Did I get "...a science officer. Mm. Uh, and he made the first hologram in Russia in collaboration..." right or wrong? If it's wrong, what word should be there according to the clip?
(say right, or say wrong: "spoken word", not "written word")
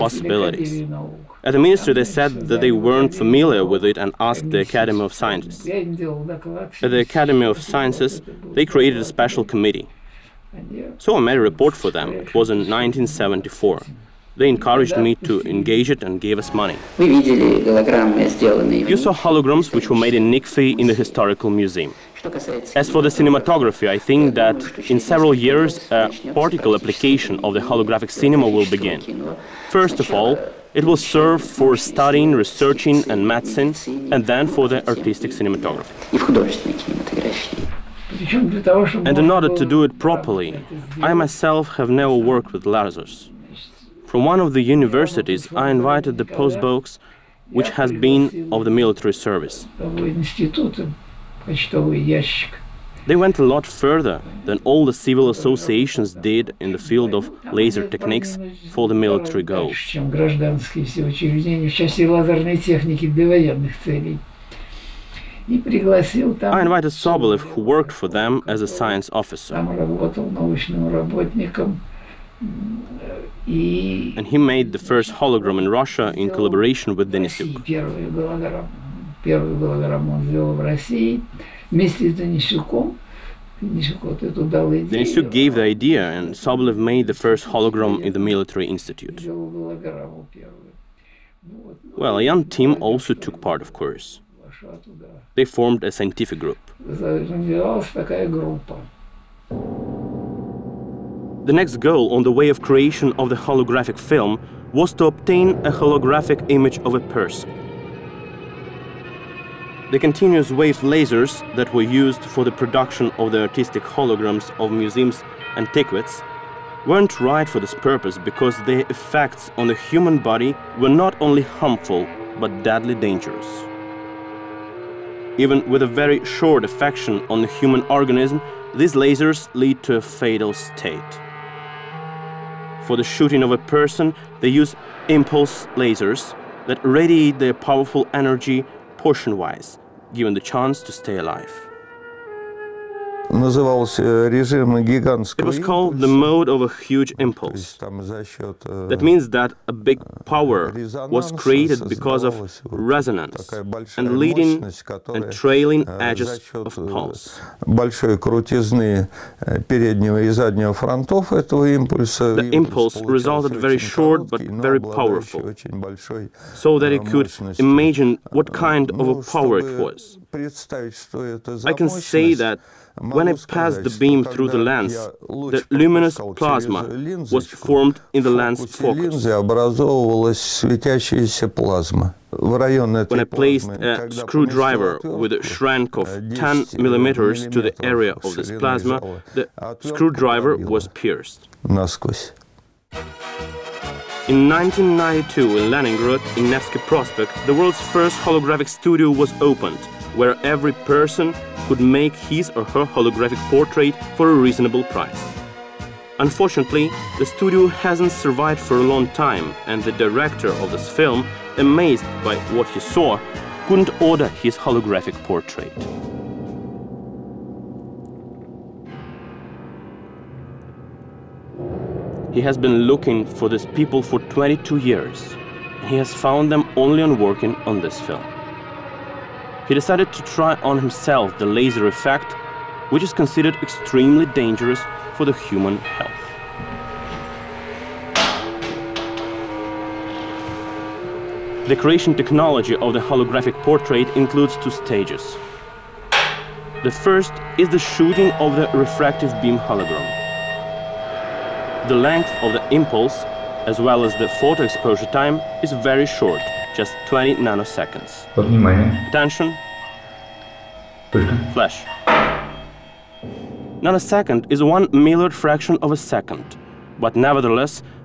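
right.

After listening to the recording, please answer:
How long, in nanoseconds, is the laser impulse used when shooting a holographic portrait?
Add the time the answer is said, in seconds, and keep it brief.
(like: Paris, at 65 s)
20 nanoseconds, at 257 s.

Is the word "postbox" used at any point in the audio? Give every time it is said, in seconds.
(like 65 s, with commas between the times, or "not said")
46 s.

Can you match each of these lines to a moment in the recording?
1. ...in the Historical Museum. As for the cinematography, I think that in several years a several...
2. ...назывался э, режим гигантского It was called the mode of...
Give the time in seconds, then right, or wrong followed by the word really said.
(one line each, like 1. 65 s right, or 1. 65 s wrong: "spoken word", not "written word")
1. 20 s wrong: "practical", not "several"
2. 143 s right.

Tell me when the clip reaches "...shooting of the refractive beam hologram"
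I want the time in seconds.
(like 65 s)
247 s.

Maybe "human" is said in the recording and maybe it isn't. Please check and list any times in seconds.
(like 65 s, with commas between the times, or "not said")
119 s, 127 s, 235 s.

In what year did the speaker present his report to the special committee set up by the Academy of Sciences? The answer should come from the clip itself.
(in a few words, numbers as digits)
1974.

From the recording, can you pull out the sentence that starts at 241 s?
The creation technology of the holographic portrait includes two stages.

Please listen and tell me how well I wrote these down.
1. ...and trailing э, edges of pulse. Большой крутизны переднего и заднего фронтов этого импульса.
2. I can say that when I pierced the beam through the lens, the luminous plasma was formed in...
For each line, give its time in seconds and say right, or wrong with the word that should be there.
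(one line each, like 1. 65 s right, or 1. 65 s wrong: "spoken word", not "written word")
1. 155 s right
2. 170 s wrong: "passed", not "pierced".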